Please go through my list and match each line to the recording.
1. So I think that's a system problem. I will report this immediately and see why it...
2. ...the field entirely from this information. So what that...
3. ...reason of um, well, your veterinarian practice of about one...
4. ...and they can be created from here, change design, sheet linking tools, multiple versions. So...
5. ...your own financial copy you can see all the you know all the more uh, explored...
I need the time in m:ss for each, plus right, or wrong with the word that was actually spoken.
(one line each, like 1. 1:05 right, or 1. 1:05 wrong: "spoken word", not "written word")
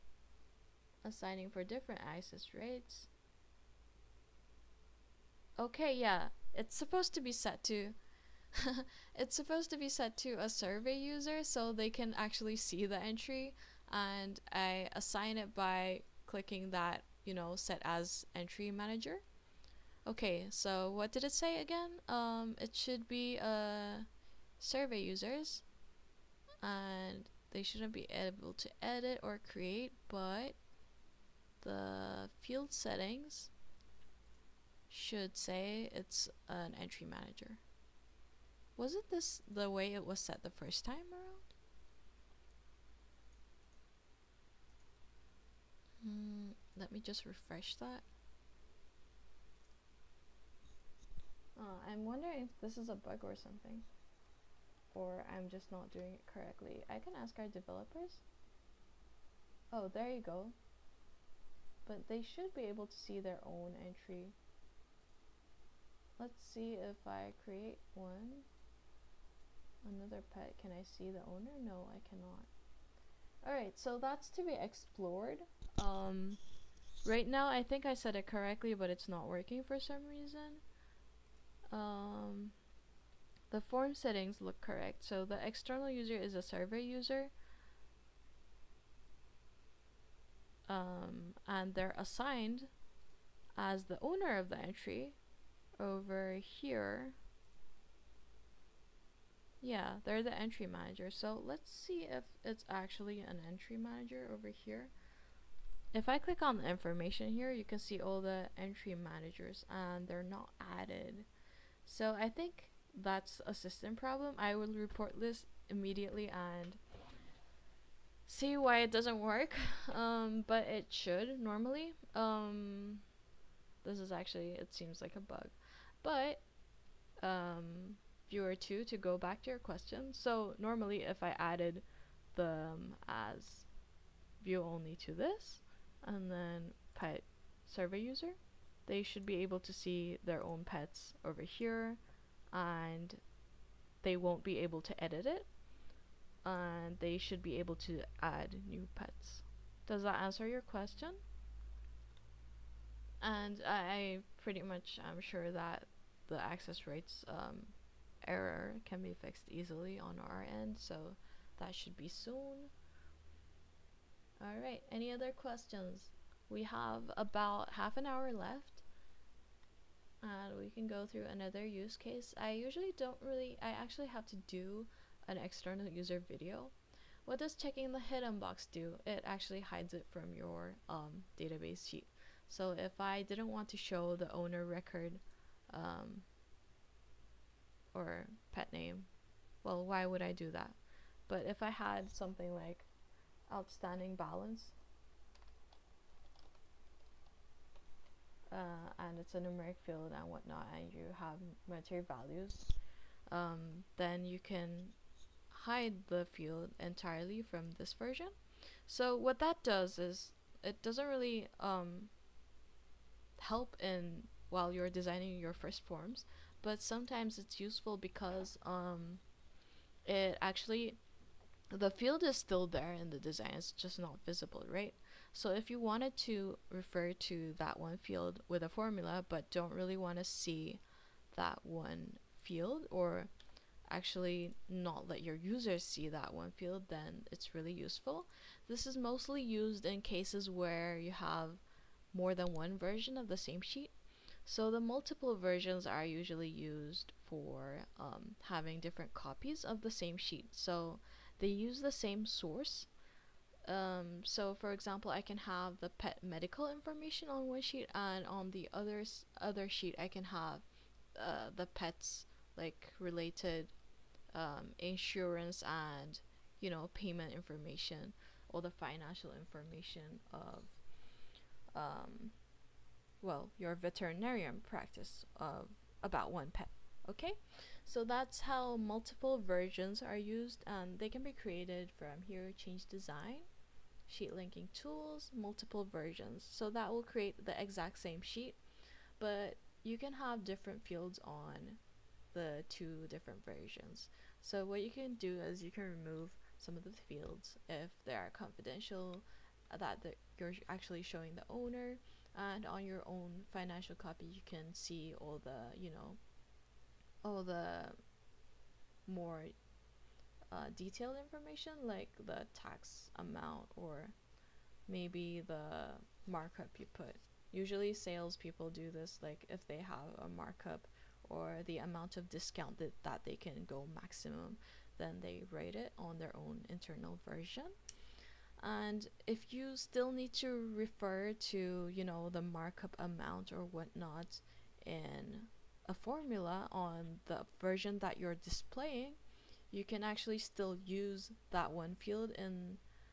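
1. 1:51 right
2. 3:26 wrong: "version", not "information"
3. 4:29 wrong: "information", not "reason"
4. 4:40 right
5. 5:02 wrong: "detailed", not "explored".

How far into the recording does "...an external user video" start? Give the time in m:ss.
2:55.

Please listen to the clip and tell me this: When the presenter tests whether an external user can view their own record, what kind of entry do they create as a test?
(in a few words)
Another pet.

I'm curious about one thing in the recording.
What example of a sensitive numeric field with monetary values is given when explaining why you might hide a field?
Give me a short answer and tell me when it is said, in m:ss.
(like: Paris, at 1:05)
outstanding balance, at 3:13.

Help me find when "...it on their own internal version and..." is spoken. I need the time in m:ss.
5:25.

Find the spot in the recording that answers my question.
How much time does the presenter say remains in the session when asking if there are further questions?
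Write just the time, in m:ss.
2:47.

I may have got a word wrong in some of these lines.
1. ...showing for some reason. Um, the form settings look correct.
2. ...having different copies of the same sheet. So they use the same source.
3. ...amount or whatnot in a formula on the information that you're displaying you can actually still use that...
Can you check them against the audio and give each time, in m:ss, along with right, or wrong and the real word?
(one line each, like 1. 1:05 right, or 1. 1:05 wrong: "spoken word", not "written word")
1. 1:19 wrong: "working", not "showing"
2. 4:08 right
3. 5:32 wrong: "version", not "information".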